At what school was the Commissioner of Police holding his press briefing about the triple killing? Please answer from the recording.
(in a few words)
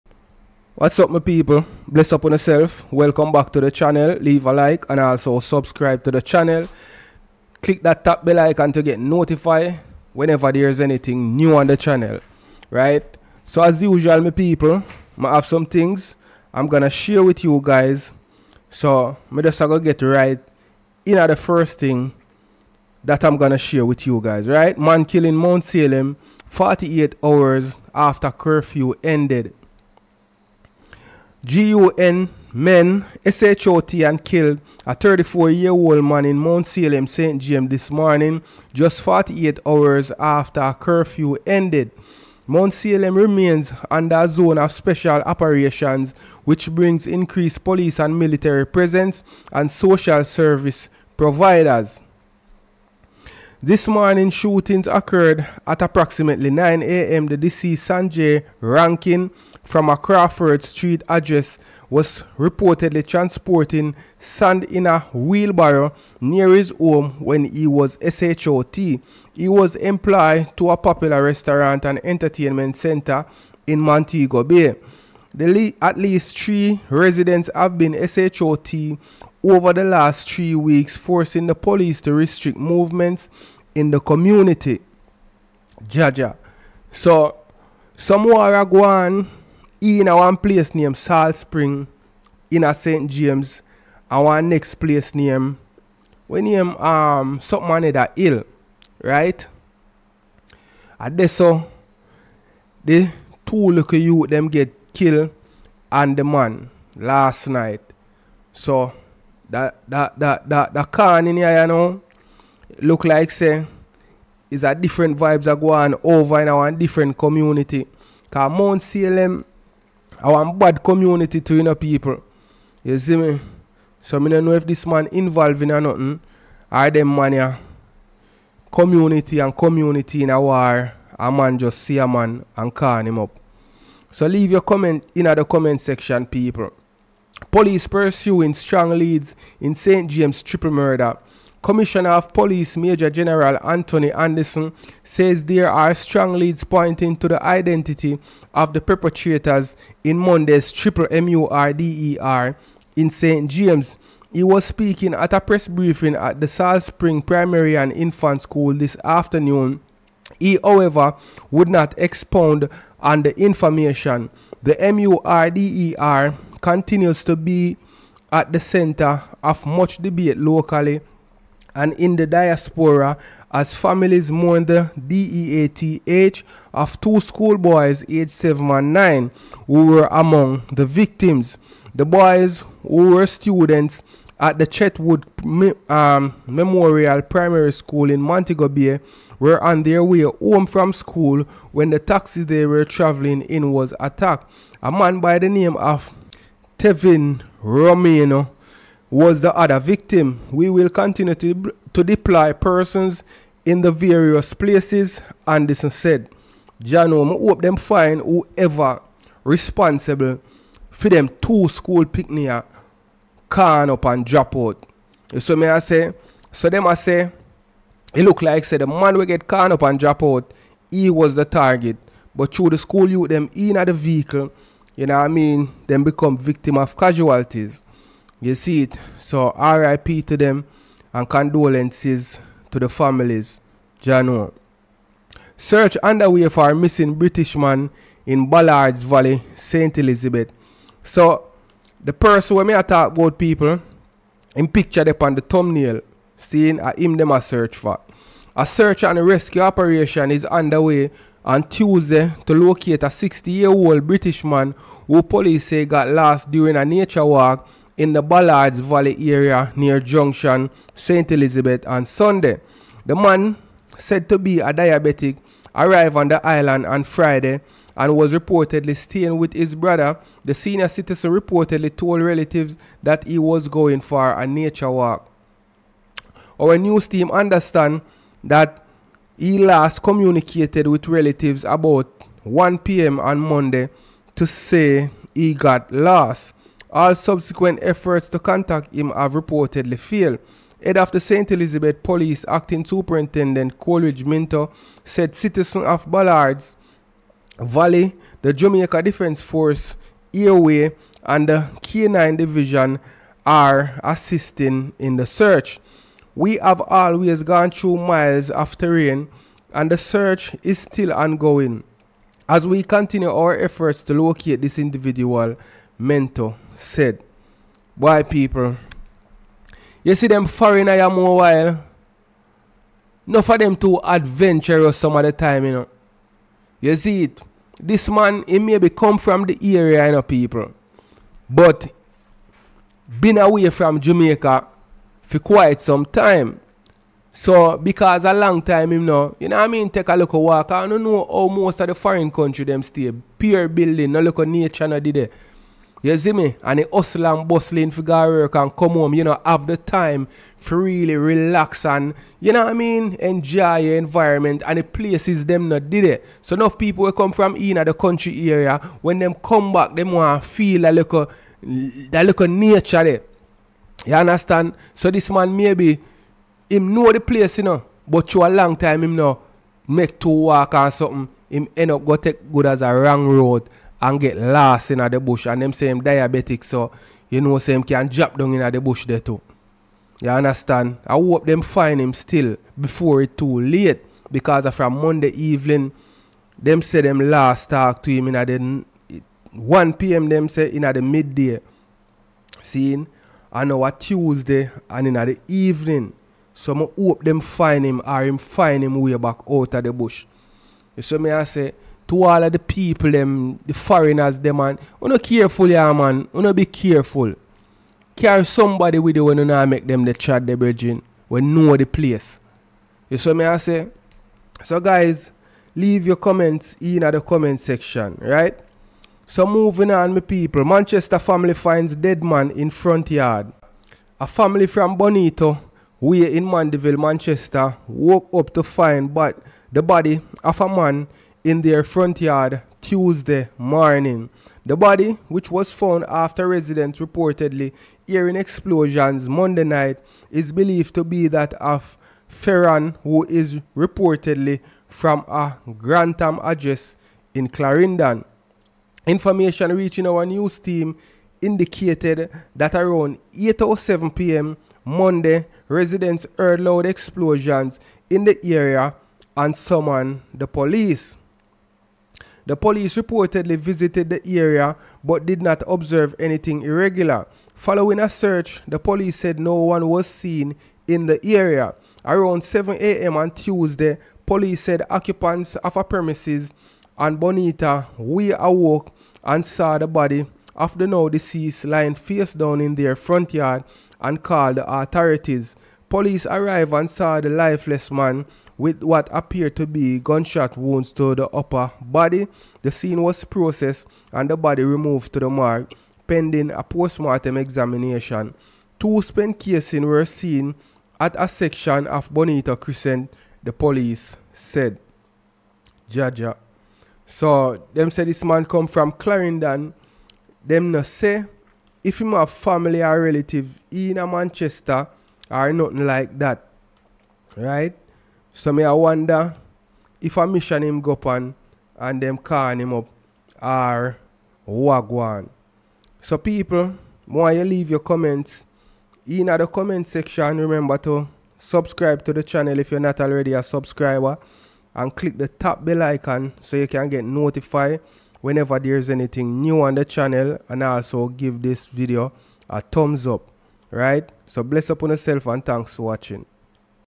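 Salt Spring Primary and Infant School.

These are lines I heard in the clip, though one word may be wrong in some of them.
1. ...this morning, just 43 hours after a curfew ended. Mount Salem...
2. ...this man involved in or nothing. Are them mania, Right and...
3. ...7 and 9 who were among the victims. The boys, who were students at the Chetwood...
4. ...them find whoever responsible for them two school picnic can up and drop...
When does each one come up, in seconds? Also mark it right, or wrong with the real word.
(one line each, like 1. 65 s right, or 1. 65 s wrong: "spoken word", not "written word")
1. 37 s wrong: "48", not "43"
2. 124 s wrong: "Community", not "Right"
3. 178 s right
4. 207 s right.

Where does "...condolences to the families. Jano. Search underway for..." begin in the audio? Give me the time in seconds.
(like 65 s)
231 s.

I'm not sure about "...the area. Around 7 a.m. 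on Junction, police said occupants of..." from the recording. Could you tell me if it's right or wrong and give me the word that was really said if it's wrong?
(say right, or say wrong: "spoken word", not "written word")
wrong: "Tuesday", not "Junction".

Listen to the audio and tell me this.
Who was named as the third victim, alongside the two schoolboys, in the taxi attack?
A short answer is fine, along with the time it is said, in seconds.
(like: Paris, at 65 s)
Tevin Romano, at 196 s.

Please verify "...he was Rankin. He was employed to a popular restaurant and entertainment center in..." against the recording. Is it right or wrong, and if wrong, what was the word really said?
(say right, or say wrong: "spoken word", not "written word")
wrong: "SHOT", not "Rankin".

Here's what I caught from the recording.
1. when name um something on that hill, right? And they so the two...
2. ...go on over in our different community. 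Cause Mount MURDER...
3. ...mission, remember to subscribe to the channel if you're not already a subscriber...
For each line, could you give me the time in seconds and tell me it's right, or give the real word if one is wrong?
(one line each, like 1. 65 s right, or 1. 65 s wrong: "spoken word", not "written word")
1. 96 s right
2. 115 s wrong: "Salem", not "MURDER"
3. 529 s wrong: "section", not "mission".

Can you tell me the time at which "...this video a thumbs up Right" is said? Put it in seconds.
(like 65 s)
541 s.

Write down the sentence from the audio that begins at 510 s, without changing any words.
Them no say if him have family or relative in Manchester, or nothing like that.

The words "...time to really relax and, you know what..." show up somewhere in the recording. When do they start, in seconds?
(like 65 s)
349 s.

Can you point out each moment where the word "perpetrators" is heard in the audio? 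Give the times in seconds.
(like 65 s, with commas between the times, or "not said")
148 s.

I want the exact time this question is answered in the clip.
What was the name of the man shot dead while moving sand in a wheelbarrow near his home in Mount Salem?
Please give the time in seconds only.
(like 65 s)
57 s.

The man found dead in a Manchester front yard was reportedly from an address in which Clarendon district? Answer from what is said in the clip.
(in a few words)
Grantham.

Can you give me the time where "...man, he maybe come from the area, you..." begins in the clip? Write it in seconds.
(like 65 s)
328 s.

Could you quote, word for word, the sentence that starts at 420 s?
Manchester family finds dead man in front yard.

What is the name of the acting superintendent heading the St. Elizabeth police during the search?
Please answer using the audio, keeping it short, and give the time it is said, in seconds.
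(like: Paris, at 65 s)
Coleridge Minter, at 293 s.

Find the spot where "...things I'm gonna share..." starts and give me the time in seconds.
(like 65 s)
15 s.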